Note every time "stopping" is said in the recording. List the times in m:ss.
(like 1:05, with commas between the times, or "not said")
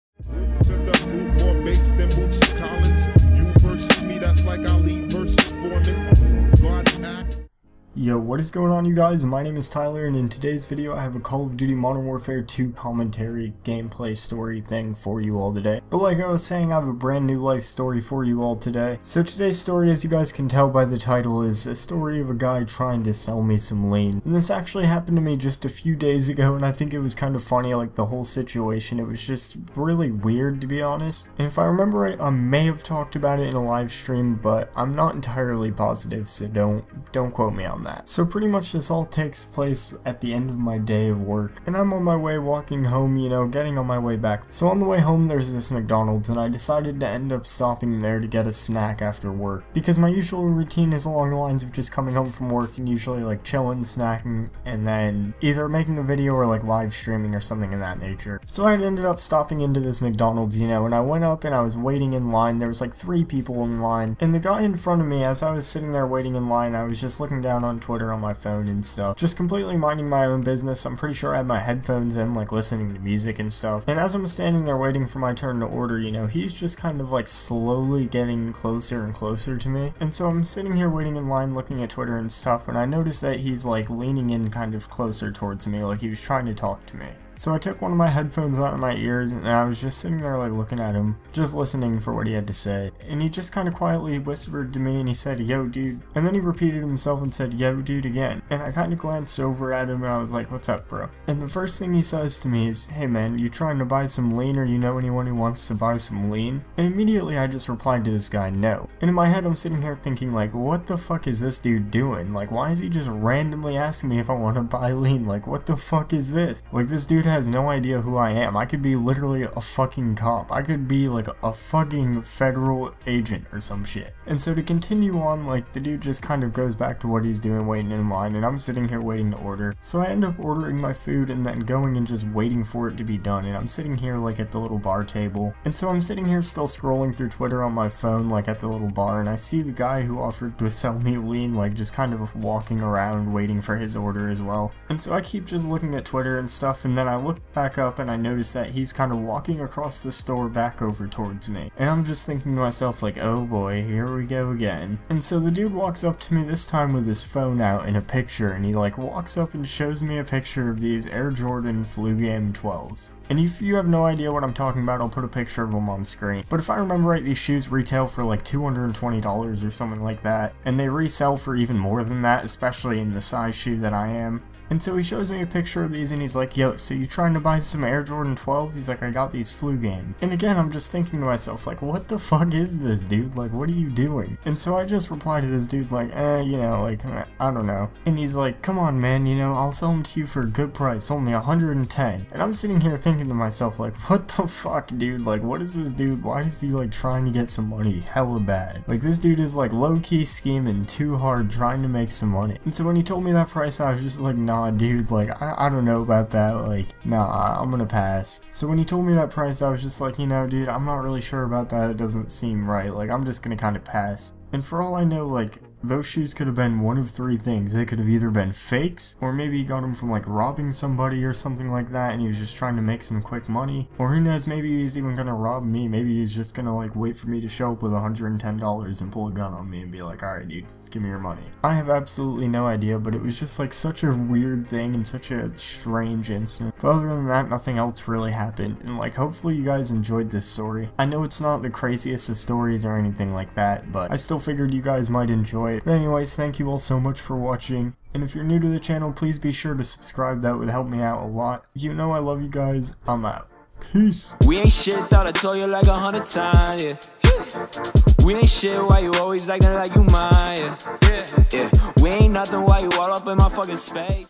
0:47, 0:59.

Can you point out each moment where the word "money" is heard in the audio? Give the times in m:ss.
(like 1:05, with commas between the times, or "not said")
3:17, 3:22, 3:43, 3:51.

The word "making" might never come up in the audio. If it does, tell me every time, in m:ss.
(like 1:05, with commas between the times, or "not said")
0:55.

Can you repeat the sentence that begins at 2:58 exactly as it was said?
He's like, I got these flu game.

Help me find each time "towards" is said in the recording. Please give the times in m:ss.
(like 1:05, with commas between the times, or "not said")
1:25, 2:31.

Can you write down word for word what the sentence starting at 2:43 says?
And if you have no idea what I'm talking about, I'll put a picture of them on screen.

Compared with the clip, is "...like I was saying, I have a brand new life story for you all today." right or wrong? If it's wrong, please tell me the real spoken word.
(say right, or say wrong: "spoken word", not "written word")
right.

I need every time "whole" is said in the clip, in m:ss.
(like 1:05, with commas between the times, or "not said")
0:28.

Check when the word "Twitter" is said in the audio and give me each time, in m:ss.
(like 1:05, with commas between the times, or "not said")
1:07, 1:21, 2:17, 2:26.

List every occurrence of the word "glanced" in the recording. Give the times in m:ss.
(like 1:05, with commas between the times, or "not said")
1:38.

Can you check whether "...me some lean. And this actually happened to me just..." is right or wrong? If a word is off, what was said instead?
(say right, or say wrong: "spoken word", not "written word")
right.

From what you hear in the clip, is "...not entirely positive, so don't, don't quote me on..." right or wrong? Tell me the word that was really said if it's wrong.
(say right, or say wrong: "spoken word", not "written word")
right.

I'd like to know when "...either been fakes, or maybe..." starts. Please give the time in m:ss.
3:38.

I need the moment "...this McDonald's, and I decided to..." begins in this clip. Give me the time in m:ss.
0:45.